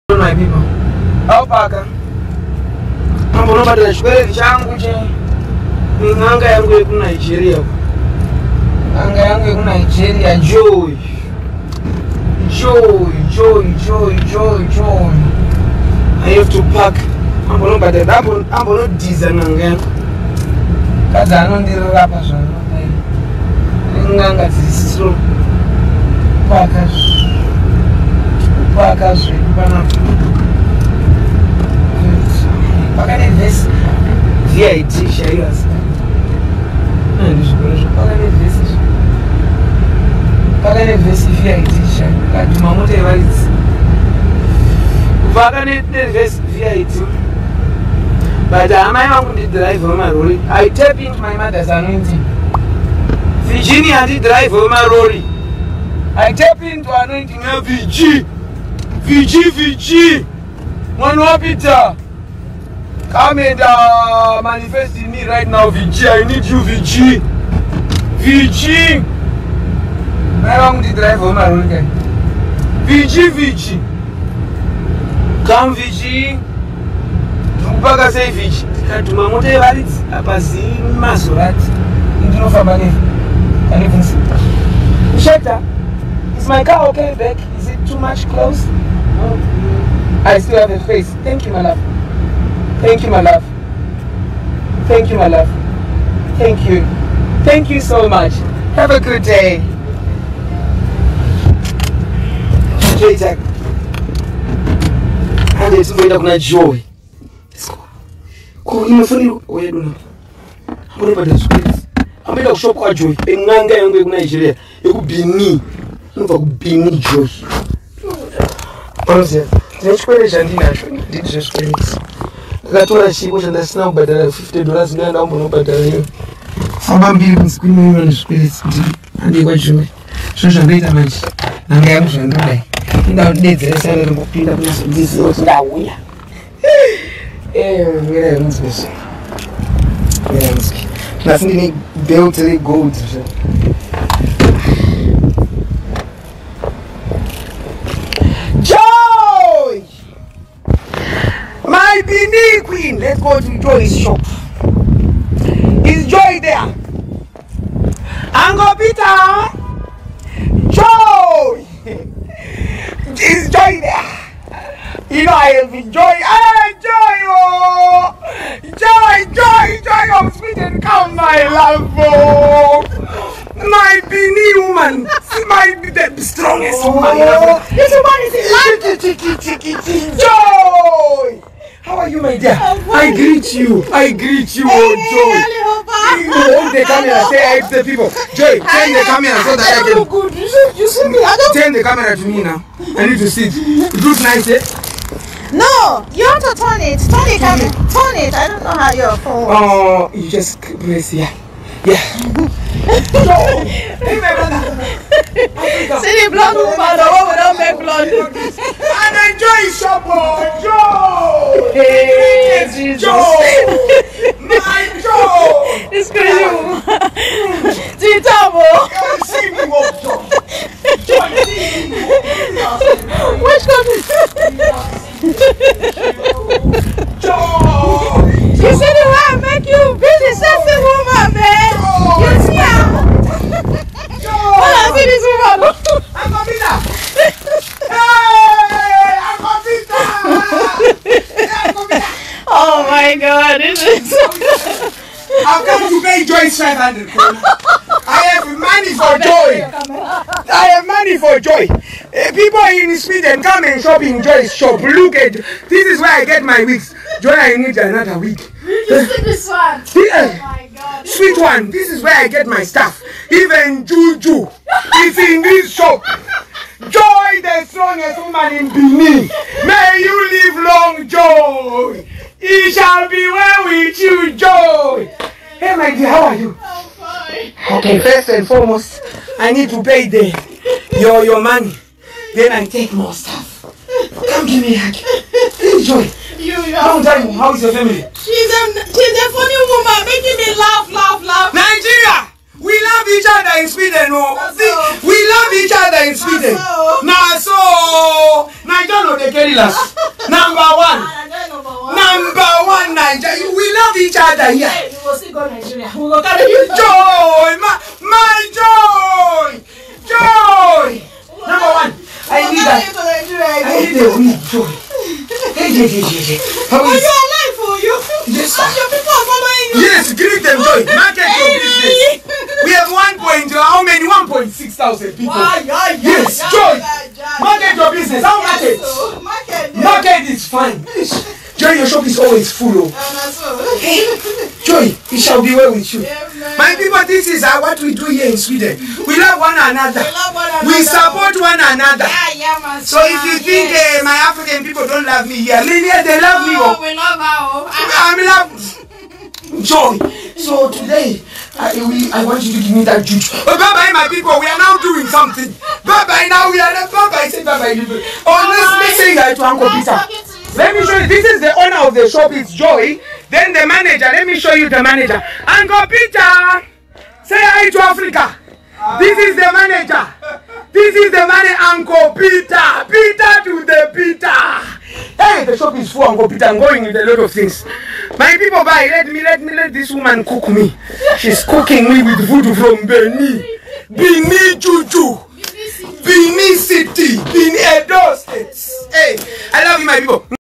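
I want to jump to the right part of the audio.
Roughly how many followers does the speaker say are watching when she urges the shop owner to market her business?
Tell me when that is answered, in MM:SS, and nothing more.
05:24.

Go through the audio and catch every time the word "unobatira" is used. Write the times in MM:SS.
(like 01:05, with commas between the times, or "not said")
00:03, 00:17.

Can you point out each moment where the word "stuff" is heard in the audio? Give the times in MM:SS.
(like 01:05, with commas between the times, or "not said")
04:22, 04:43.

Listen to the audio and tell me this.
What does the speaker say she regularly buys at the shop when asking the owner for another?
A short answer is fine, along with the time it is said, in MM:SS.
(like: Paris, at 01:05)
wigs, at 04:16.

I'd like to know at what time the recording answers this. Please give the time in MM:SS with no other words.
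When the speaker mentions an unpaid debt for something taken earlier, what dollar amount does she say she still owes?
02:04.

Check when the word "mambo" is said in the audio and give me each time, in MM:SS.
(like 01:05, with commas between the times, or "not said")
00:03, 00:17.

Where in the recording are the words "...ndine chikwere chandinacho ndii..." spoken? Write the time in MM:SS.
01:59.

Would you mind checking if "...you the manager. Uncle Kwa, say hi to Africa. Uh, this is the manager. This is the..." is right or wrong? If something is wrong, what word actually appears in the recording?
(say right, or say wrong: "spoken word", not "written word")
wrong: "Peter", not "Kwa".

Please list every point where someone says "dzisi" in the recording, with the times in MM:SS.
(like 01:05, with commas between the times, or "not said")
00:24.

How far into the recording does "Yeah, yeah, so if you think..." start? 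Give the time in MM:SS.
05:42.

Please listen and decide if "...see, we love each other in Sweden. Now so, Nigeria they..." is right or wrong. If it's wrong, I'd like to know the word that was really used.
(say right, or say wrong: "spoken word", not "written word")
right.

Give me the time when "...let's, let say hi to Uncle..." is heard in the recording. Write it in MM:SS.
05:58.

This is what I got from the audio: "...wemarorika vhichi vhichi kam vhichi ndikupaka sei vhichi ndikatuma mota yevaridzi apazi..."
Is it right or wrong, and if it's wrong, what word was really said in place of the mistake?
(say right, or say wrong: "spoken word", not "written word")
right.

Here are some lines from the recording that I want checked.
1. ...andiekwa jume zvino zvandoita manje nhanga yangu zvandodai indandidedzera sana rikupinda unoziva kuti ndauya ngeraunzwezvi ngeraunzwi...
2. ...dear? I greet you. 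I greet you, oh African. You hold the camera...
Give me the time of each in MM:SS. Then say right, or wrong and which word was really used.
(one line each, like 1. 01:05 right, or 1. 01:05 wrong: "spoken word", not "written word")
1. 02:09 wrong: "kunazondiziva", not "unoziva"
2. 03:02 wrong: "Joy", not "African".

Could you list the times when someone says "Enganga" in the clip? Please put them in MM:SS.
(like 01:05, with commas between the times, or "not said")
01:53.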